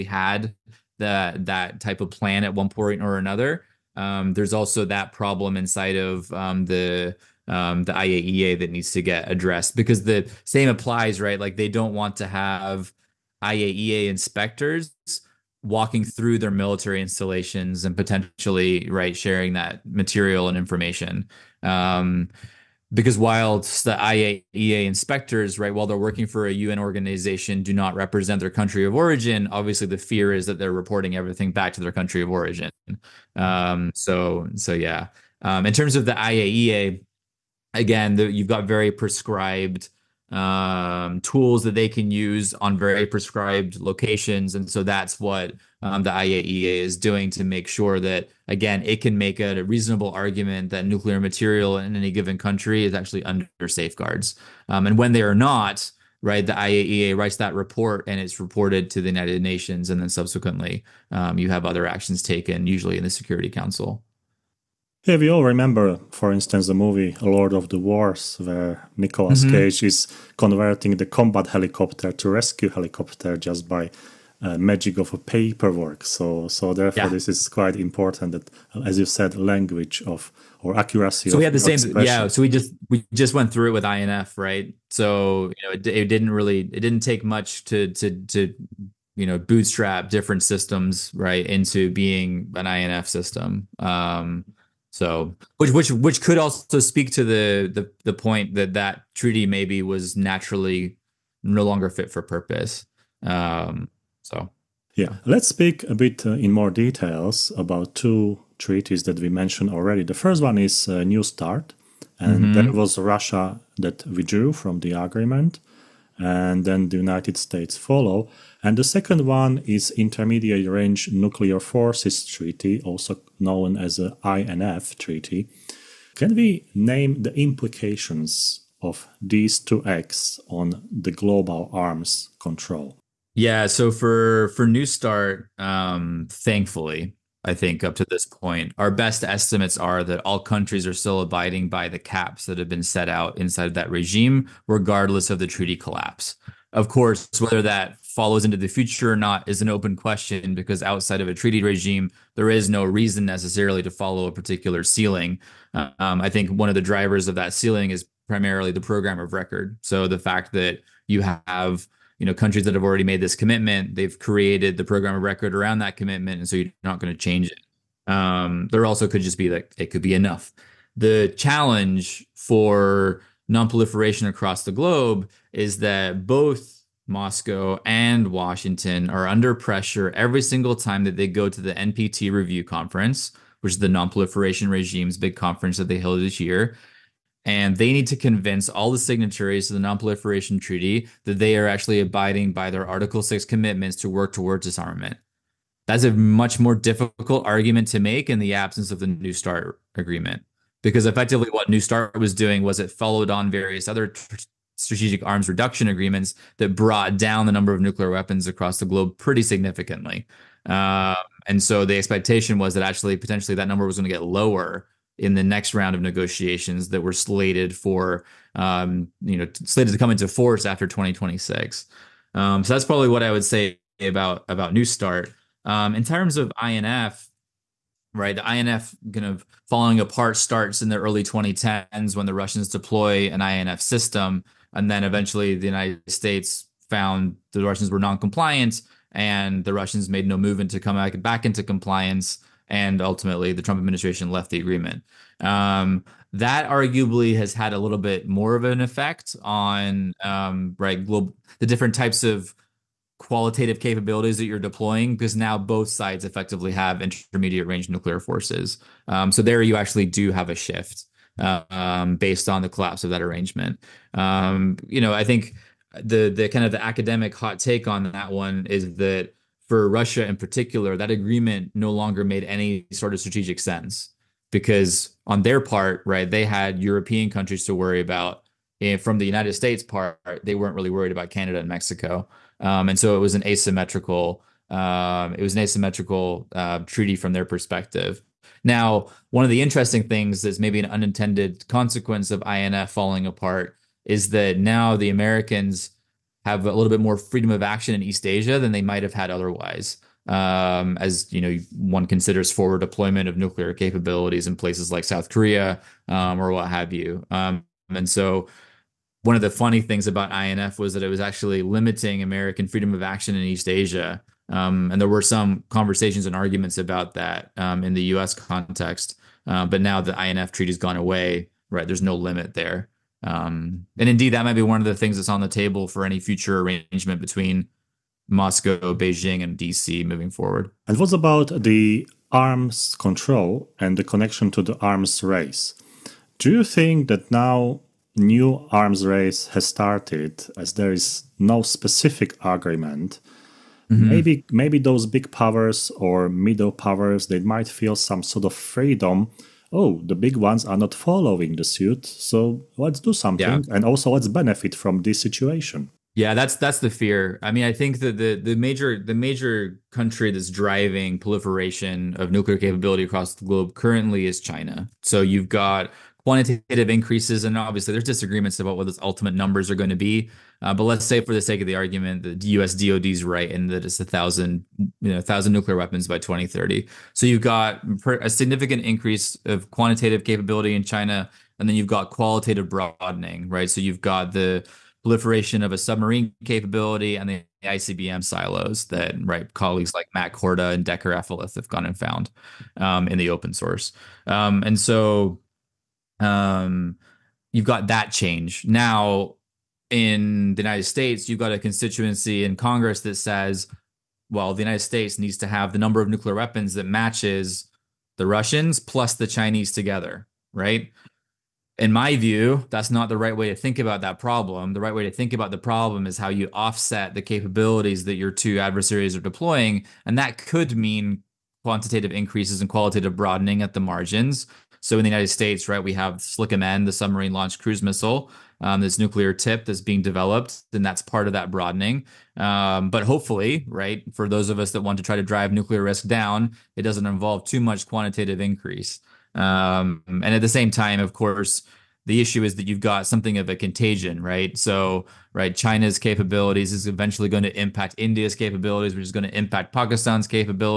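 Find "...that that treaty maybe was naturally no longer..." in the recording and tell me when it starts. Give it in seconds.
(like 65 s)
98 s.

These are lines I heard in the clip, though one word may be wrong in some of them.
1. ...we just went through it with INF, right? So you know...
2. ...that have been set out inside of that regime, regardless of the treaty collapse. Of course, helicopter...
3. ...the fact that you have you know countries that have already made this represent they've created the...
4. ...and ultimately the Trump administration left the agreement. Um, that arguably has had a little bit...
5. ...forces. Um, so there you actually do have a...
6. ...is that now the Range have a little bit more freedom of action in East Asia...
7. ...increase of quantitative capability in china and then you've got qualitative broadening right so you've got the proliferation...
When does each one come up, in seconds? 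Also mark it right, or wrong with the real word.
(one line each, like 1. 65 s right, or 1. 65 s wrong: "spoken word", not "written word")
1. 82 s right
2. 142 s wrong: "whether", not "helicopter"
3. 160 s wrong: "commitment", not "represent"
4. 242 s right
5. 258 s right
6. 294 s wrong: "Americans", not "Range"
7. 378 s right.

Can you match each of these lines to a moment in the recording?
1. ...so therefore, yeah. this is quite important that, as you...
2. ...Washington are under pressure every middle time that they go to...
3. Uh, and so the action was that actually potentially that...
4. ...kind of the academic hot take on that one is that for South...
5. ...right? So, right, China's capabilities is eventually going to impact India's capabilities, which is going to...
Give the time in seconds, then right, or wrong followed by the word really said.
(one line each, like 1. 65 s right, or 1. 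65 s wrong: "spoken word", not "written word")
1. 76 s right
2. 178 s wrong: "single", not "middle"
3. 210 s wrong: "expectation", not "action"
4. 266 s wrong: "Russia", not "South"
5. 444 s right.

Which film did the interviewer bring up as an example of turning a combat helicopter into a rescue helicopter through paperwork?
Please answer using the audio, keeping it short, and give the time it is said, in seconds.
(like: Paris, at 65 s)
Lord of the Wars, at 67 s.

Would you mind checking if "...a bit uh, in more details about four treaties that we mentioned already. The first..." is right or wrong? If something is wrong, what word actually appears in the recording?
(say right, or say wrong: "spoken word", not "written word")
wrong: "two", not "four".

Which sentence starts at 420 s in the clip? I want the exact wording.
And that could mean quantitative increases and qualitative broadening at the margins.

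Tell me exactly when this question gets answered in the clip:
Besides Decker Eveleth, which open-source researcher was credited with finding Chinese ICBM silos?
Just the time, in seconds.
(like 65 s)
390 s.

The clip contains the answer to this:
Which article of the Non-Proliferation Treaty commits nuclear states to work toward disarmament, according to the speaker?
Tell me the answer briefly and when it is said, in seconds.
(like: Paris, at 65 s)
Article 6, at 192 s.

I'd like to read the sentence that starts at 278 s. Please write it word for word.
And from the United States part, they weren't really worried about Canada and Mexico.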